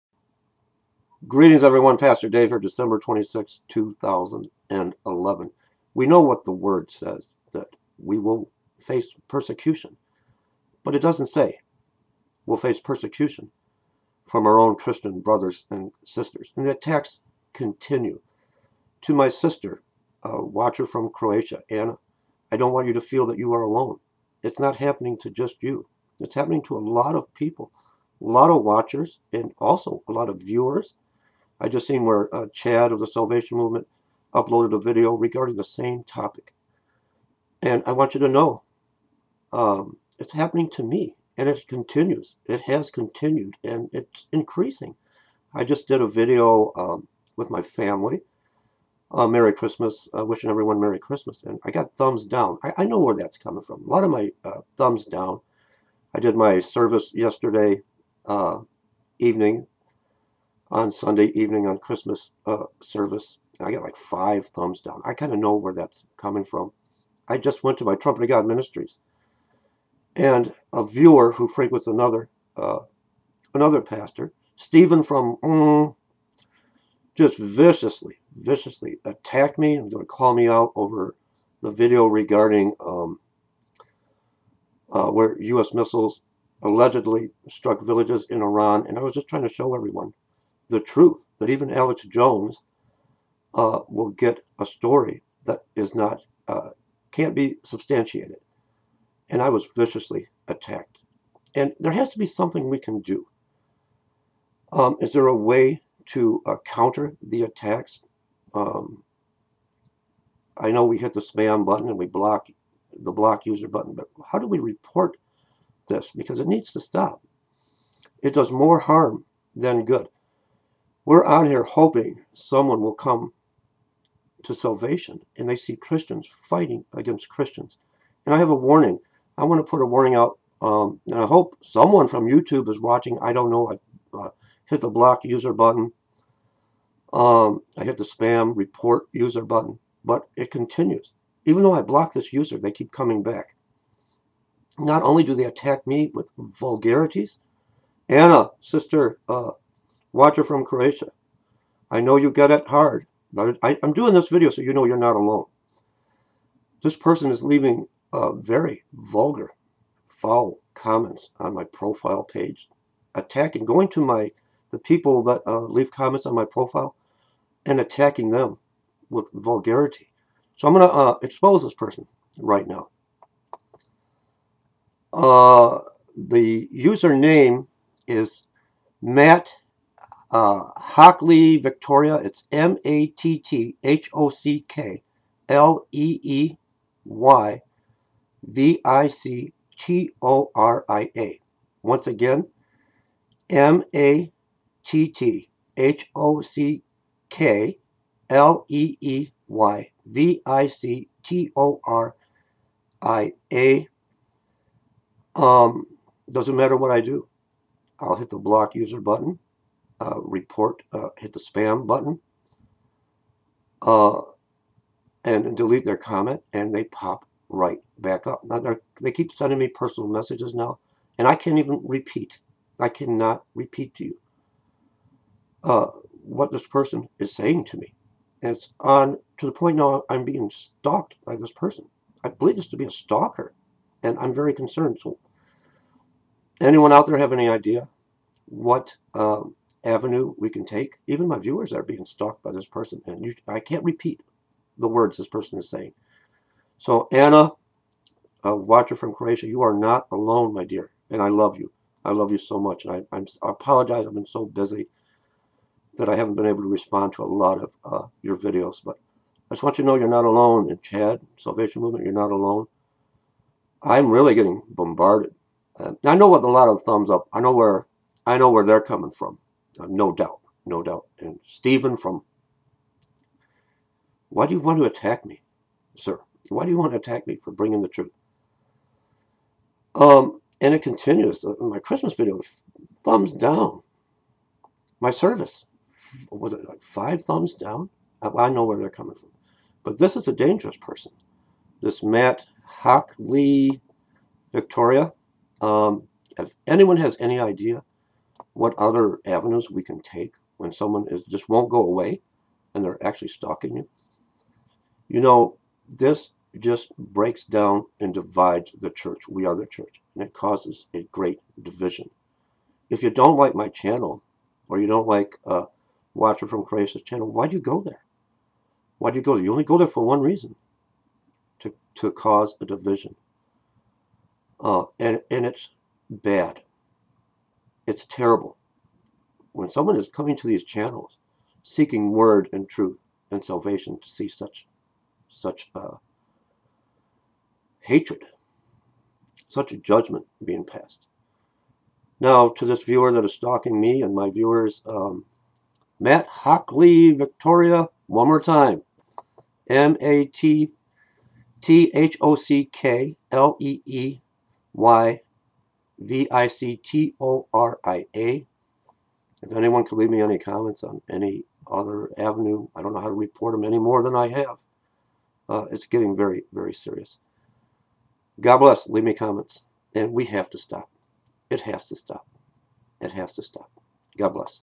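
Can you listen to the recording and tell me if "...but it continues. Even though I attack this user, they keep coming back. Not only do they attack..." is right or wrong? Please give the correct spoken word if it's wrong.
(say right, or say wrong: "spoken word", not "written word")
wrong: "block", not "attack".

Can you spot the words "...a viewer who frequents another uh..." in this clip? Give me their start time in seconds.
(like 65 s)
70 s.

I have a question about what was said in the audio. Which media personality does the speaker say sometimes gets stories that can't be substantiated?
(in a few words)
Alex Jones.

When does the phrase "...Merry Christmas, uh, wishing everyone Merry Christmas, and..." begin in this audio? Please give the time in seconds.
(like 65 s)
49 s.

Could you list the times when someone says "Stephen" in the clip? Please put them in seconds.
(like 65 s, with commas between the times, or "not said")
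74 s, 271 s.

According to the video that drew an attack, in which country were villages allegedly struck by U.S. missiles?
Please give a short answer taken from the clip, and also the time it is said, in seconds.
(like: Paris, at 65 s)
Iran, at 88 s.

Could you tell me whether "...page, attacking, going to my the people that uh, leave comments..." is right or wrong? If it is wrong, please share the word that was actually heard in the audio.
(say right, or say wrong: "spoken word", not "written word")
right.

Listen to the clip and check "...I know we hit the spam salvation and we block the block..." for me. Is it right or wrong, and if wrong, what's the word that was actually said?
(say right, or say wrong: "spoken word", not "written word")
wrong: "button", not "salvation".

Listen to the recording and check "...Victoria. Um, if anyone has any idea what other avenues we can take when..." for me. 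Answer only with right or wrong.
right.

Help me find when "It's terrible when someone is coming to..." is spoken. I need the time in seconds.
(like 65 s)
327 s.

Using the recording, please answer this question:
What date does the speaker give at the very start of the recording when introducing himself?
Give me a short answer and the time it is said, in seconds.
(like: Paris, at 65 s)
December 26, 2011, at 2 s.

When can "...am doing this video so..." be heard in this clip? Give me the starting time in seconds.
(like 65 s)
153 s.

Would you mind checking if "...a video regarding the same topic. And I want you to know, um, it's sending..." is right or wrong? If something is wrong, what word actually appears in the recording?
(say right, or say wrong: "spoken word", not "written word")
wrong: "happening", not "sending".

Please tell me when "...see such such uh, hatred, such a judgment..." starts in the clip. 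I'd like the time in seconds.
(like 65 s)
334 s.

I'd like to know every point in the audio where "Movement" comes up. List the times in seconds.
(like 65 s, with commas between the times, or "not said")
33 s, 261 s.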